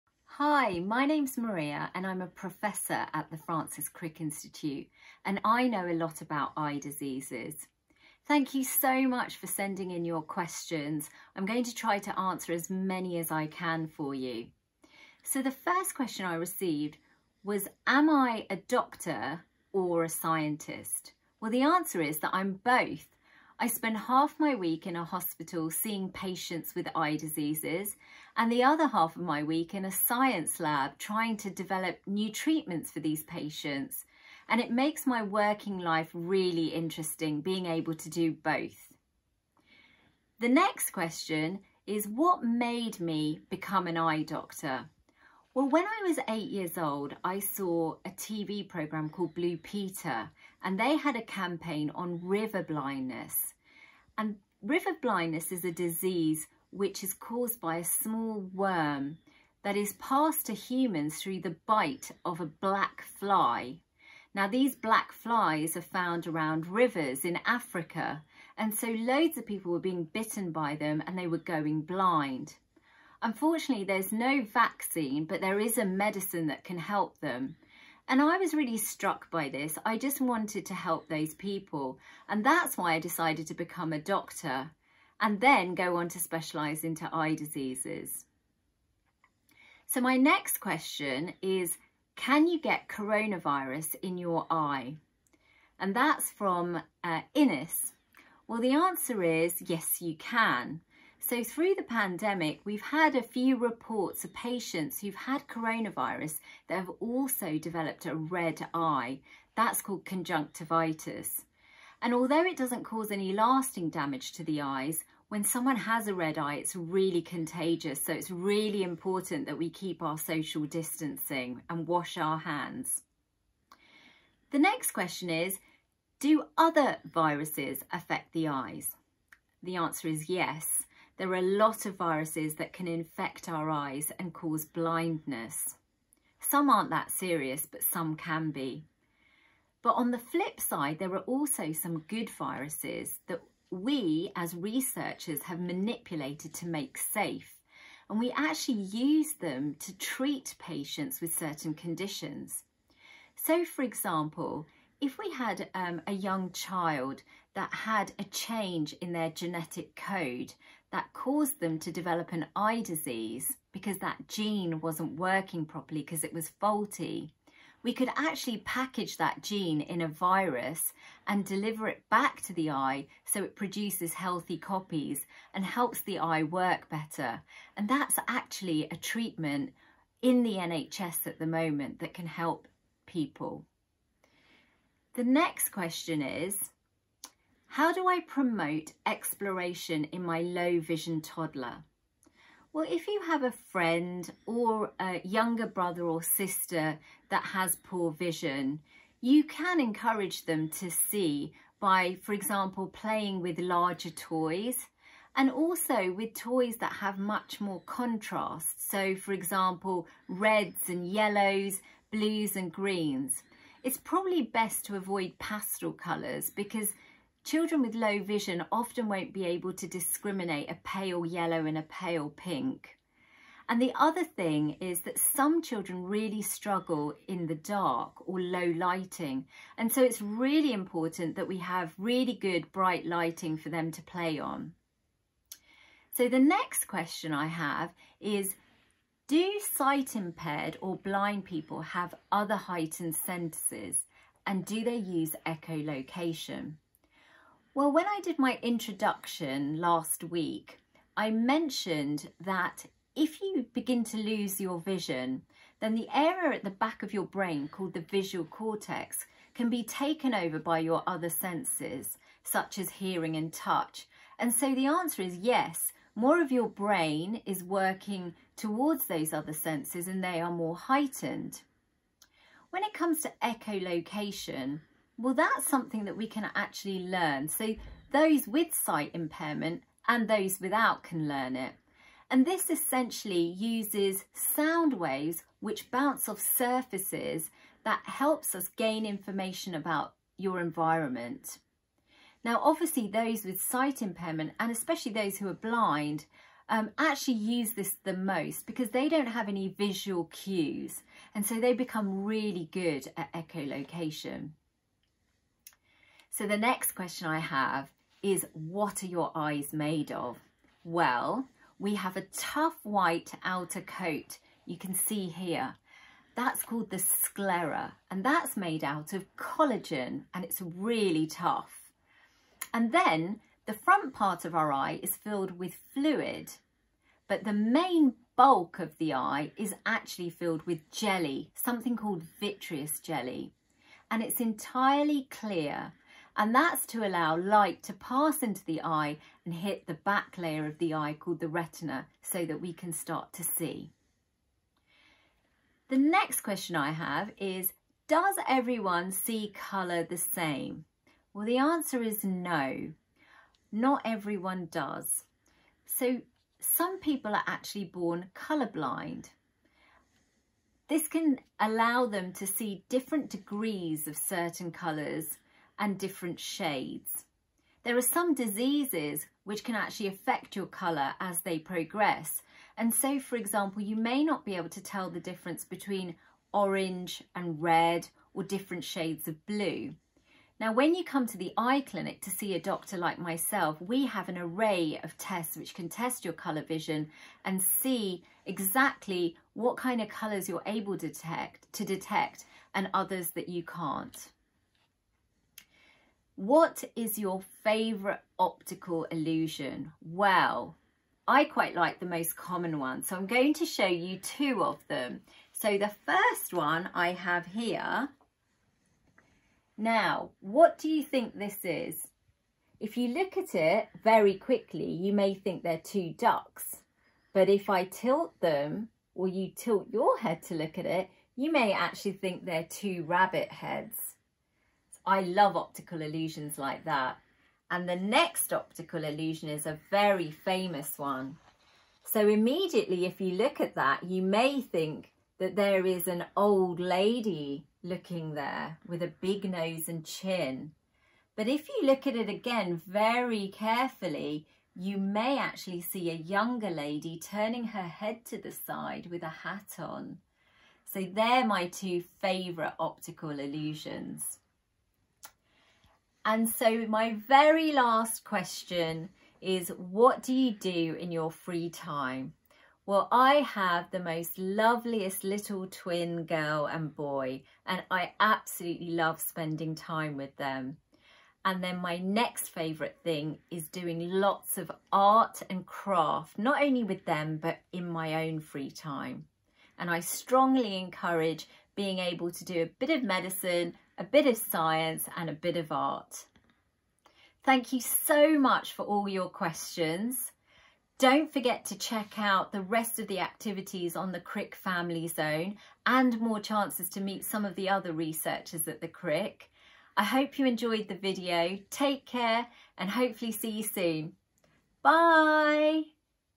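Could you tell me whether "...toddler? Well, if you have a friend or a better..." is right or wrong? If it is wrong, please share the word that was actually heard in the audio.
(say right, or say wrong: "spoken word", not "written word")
wrong: "younger", not "better".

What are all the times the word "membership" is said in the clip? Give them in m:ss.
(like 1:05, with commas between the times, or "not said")
not said.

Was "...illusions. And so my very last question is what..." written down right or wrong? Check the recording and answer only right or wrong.
right.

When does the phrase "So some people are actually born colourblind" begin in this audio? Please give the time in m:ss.
5:55.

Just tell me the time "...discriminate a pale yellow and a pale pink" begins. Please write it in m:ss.
3:39.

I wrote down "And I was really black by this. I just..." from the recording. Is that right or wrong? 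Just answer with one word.
wrong.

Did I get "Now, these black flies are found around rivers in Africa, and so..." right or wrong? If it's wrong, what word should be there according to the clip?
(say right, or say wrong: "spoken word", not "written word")
right.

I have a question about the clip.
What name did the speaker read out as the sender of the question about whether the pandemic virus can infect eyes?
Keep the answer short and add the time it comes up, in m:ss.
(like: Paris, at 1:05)
Innes, at 1:37.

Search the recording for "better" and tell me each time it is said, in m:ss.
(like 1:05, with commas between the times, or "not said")
2:56.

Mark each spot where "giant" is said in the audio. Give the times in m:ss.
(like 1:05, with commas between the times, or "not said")
not said.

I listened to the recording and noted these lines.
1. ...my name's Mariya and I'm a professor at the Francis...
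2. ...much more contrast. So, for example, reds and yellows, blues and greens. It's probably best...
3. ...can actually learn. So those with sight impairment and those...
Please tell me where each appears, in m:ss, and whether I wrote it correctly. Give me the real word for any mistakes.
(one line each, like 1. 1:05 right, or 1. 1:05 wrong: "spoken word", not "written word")
1. 0:00 right
2. 3:27 right
3. 4:36 right.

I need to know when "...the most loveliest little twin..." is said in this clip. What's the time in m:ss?
7:43.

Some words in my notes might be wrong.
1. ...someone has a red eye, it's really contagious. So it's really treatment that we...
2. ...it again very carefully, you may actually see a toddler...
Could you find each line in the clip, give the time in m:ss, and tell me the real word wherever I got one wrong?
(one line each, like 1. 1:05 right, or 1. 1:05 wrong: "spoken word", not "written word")
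1. 1:55 wrong: "important", not "treatment"
2. 7:22 wrong: "younger", not "toddler".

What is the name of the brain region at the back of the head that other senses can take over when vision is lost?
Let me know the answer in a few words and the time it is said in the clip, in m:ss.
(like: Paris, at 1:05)
visual cortex, at 4:18.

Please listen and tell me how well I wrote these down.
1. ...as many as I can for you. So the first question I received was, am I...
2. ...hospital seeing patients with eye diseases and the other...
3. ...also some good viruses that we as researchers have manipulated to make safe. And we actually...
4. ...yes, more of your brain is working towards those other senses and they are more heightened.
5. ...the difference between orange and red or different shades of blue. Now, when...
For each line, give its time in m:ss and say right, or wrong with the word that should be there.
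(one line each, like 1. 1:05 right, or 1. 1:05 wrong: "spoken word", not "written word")
1. 0:12 right
2. 0:25 right
3. 2:21 right
4. 4:25 right
5. 6:15 right.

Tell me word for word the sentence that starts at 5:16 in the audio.
That's called the sclera and that's made out of collagen and it's really tough.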